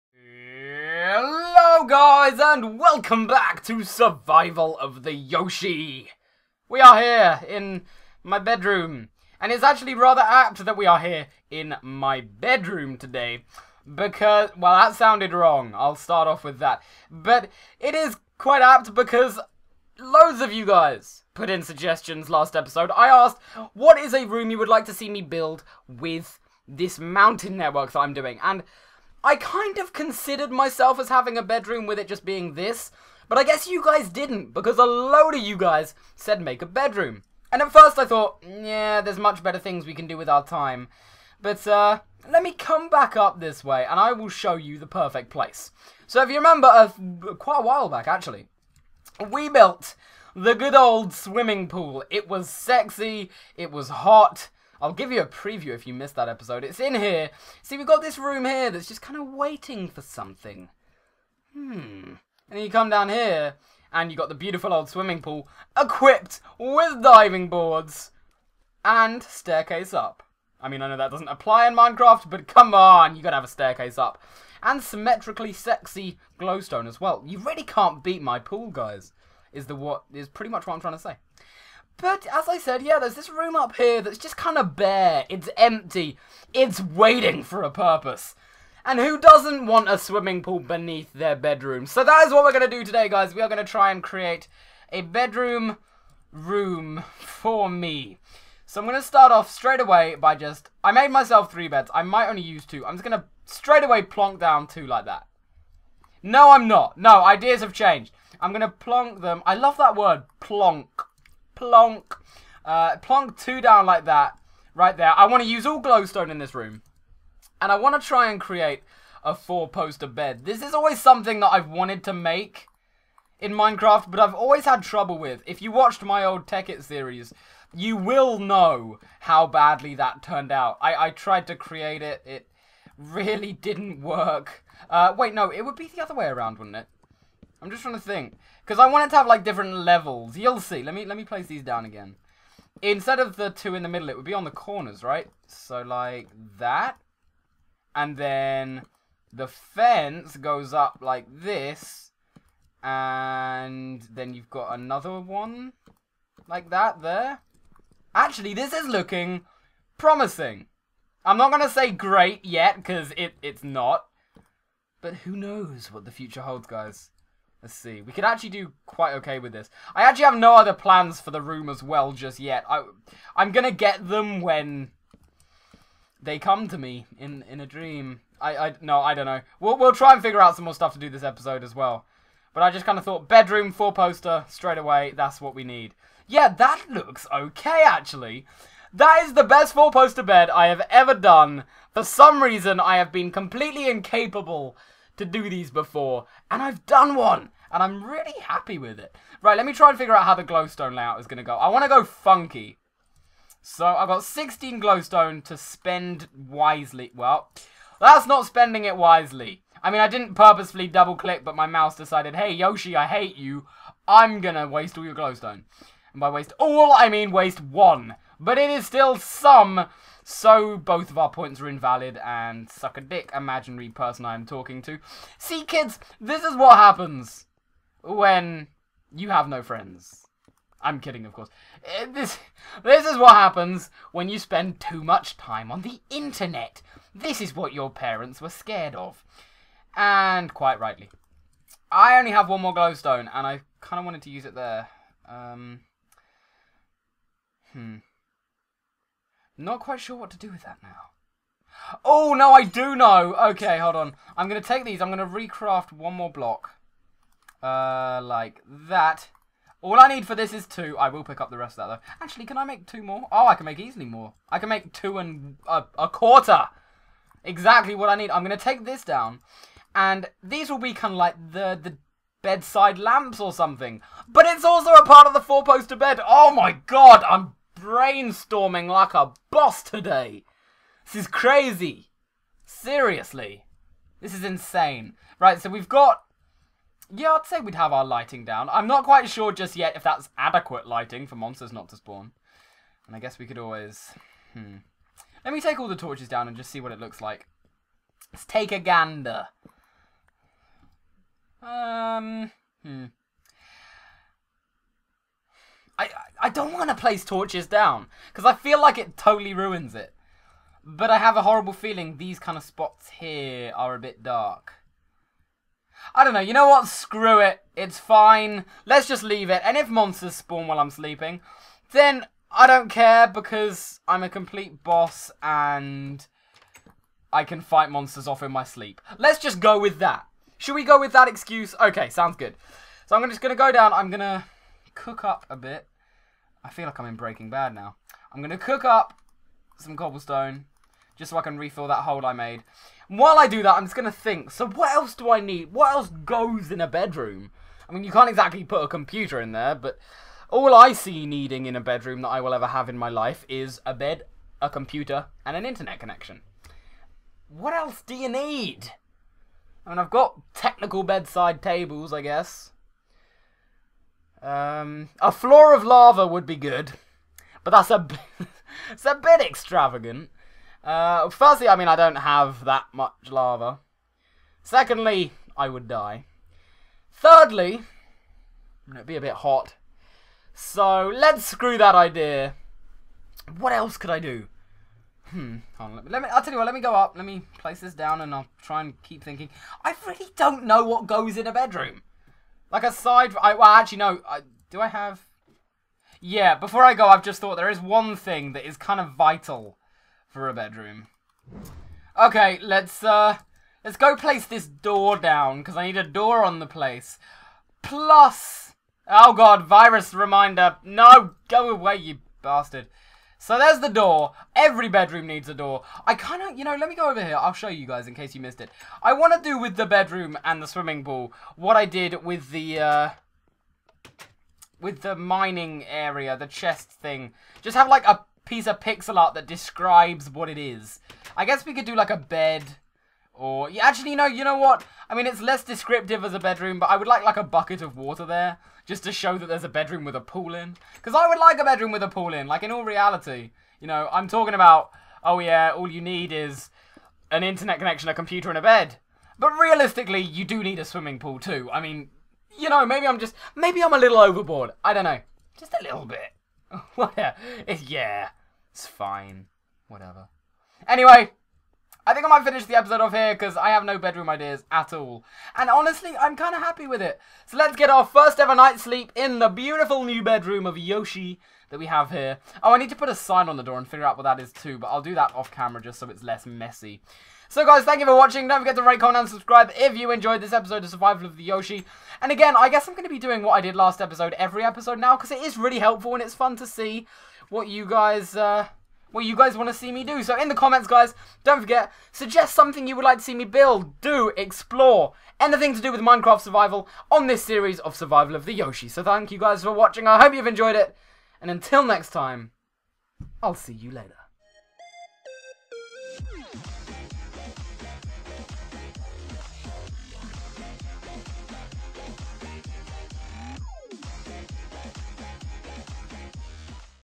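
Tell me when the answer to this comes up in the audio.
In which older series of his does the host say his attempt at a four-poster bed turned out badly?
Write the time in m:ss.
2:06.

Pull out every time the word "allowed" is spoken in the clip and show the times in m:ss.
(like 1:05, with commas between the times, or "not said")
not said.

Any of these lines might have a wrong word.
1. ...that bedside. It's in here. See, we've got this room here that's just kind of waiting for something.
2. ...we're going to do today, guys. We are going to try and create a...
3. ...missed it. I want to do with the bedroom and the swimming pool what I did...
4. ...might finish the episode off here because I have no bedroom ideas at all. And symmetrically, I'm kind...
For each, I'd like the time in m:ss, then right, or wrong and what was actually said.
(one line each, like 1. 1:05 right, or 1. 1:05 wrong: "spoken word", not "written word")
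1. 0:56 wrong: "episode", not "bedside"
2. 1:32 right
3. 6:58 right
4. 7:42 wrong: "honestly", not "symmetrically".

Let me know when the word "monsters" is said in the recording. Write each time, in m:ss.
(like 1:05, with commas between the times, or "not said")
4:51, 5:19, 5:27.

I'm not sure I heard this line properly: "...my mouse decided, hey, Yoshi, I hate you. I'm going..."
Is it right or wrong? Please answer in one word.
right.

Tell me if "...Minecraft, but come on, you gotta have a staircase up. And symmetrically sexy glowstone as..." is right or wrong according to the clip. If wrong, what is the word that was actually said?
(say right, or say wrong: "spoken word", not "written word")
right.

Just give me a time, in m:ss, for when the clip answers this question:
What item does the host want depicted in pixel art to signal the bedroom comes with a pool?
7:17.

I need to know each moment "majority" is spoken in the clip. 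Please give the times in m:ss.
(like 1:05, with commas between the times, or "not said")
not said.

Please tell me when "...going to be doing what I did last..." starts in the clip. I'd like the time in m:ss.
8:02.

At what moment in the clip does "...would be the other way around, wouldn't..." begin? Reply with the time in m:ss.
2:15.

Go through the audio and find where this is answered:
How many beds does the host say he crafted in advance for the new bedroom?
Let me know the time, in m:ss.
1:41.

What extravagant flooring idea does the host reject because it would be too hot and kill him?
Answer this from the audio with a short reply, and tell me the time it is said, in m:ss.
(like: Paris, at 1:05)
floor of lava, at 6:05.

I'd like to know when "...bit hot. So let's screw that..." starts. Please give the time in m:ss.
6:19.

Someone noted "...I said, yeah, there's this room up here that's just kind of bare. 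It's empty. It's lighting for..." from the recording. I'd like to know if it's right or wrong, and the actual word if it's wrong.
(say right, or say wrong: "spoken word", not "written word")
wrong: "waiting", not "lighting".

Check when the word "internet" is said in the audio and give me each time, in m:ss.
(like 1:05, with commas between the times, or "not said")
3:56, 5:55, 7:27.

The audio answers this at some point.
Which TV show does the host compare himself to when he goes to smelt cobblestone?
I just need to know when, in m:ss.
5:37.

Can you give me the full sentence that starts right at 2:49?
I actually have no other plans for the room as well just yet.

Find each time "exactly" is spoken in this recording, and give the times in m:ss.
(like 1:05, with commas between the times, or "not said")
4:27, 5:48.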